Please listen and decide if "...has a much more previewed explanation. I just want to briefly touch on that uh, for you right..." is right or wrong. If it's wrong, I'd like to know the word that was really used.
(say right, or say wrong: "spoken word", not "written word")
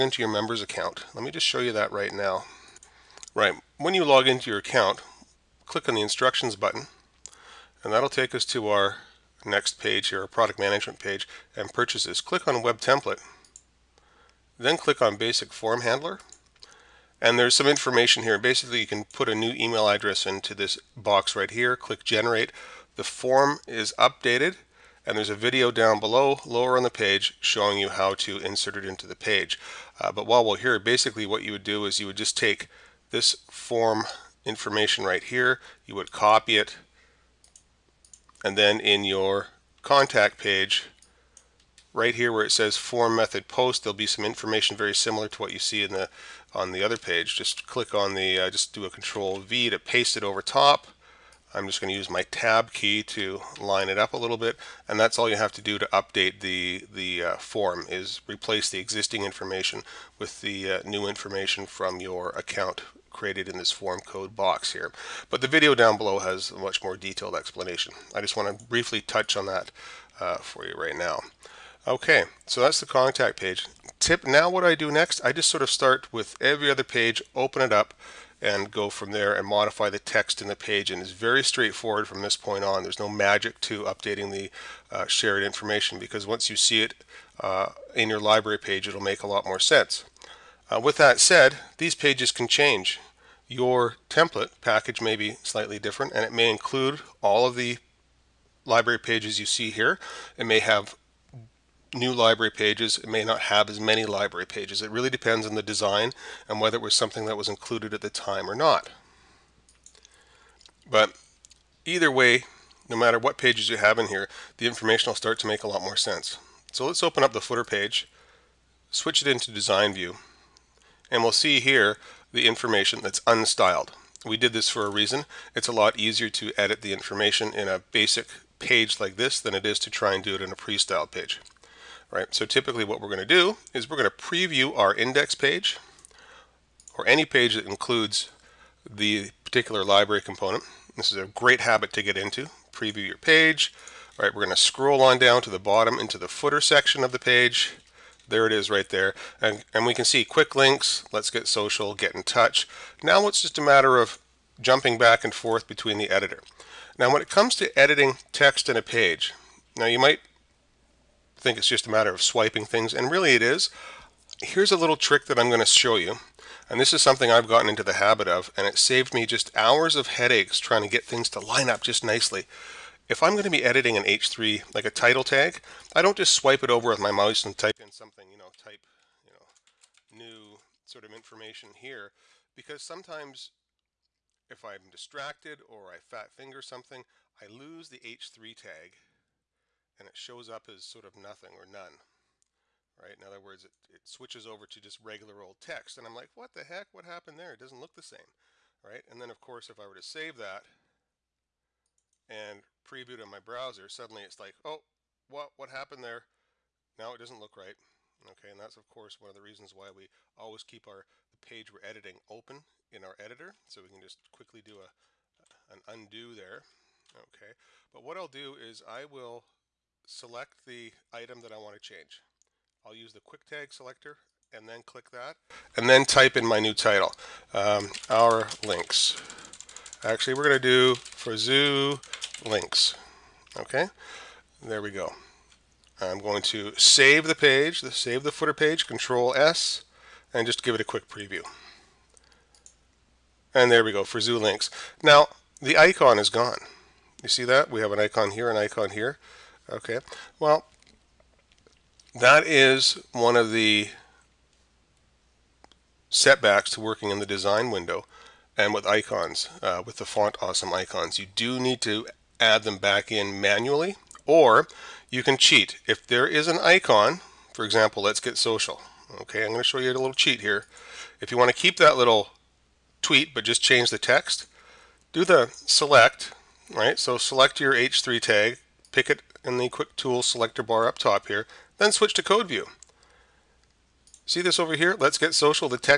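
wrong: "detailed", not "previewed".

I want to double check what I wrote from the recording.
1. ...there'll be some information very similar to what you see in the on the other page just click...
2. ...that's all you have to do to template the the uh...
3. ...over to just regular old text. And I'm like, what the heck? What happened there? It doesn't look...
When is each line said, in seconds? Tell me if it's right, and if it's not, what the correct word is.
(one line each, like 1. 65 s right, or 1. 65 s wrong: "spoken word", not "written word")
1. 43 s right
2. 54 s wrong: "update", not "template"
3. 194 s right.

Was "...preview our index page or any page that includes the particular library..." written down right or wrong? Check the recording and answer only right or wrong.
right.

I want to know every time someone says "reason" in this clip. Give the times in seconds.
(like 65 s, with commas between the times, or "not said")
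124 s, 209 s.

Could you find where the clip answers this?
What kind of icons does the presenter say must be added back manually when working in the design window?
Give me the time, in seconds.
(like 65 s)
260 s.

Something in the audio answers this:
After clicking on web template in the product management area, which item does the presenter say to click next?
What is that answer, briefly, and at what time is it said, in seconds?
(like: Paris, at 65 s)
basic form handler, at 15 s.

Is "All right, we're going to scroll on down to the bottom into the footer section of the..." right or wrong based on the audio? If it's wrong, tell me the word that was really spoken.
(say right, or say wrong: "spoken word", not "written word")
right.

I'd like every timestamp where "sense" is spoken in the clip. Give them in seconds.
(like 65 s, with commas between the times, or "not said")
89 s, 115 s.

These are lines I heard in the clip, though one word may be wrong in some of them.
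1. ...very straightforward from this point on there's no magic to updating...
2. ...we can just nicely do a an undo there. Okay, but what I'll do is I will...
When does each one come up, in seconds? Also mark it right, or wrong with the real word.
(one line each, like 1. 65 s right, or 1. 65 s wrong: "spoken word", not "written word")
1. 81 s right
2. 213 s wrong: "quickly", not "nicely".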